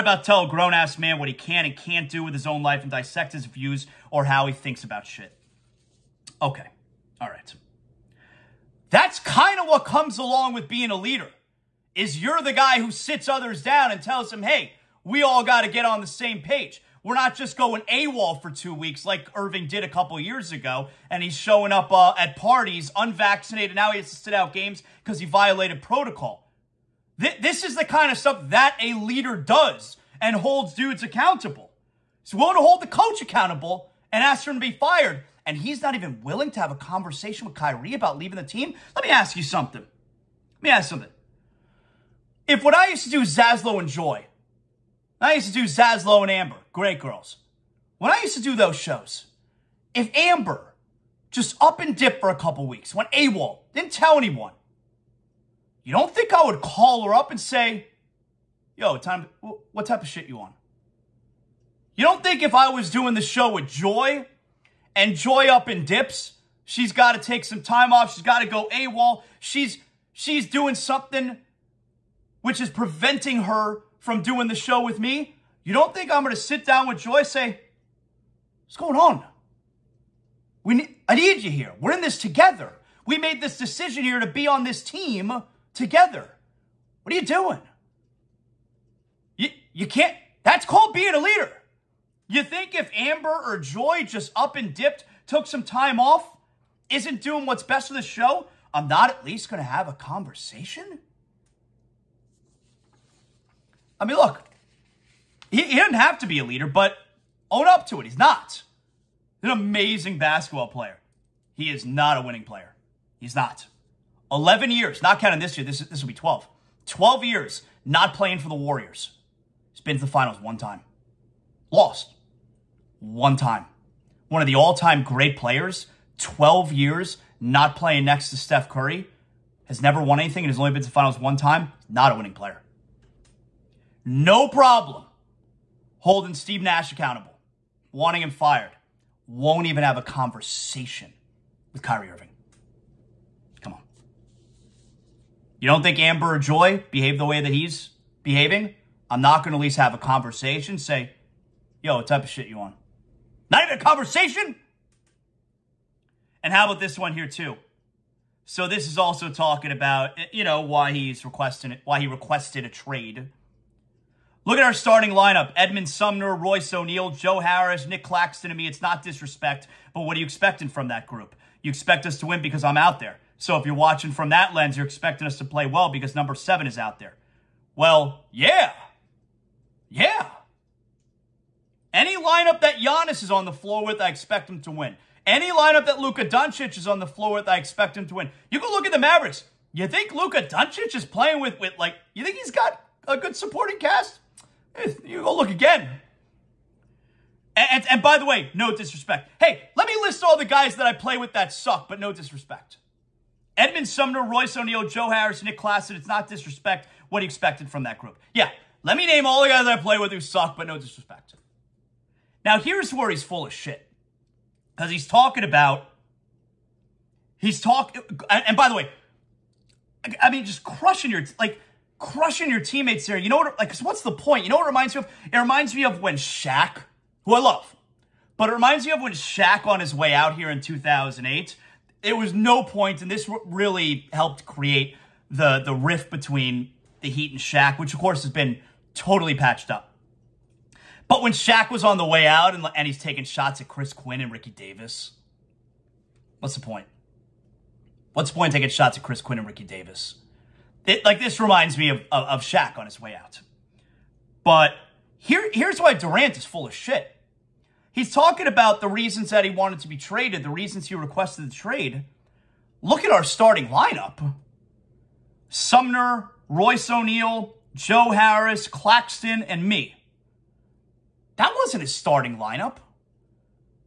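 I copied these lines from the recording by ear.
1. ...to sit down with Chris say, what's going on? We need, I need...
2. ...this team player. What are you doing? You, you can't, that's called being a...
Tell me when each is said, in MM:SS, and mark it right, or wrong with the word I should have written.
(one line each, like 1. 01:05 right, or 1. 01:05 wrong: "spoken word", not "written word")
1. 01:16 wrong: "Joy", not "Chris"
2. 01:24 wrong: "together", not "player".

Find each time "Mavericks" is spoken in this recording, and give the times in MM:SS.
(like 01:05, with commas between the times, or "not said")
03:08.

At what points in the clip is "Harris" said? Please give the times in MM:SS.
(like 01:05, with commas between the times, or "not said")
02:47, 03:25, 04:28.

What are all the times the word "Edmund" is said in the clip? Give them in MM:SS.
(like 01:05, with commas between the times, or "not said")
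02:45, 03:23.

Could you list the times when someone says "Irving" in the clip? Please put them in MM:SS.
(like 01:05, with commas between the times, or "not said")
00:19, 02:22.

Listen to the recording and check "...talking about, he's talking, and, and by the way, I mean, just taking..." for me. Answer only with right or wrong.
wrong.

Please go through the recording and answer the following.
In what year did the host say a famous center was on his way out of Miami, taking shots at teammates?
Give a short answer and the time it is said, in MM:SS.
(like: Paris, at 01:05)
2008, at 03:50.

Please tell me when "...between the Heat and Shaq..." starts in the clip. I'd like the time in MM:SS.
03:56.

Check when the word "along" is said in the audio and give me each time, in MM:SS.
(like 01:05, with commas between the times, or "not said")
00:10.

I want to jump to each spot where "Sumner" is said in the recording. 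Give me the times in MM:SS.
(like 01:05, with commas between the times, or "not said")
02:45, 03:23, 04:25.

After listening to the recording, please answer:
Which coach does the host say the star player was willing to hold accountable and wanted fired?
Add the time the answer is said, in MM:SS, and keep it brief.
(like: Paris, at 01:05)
Steve Nash, at 02:16.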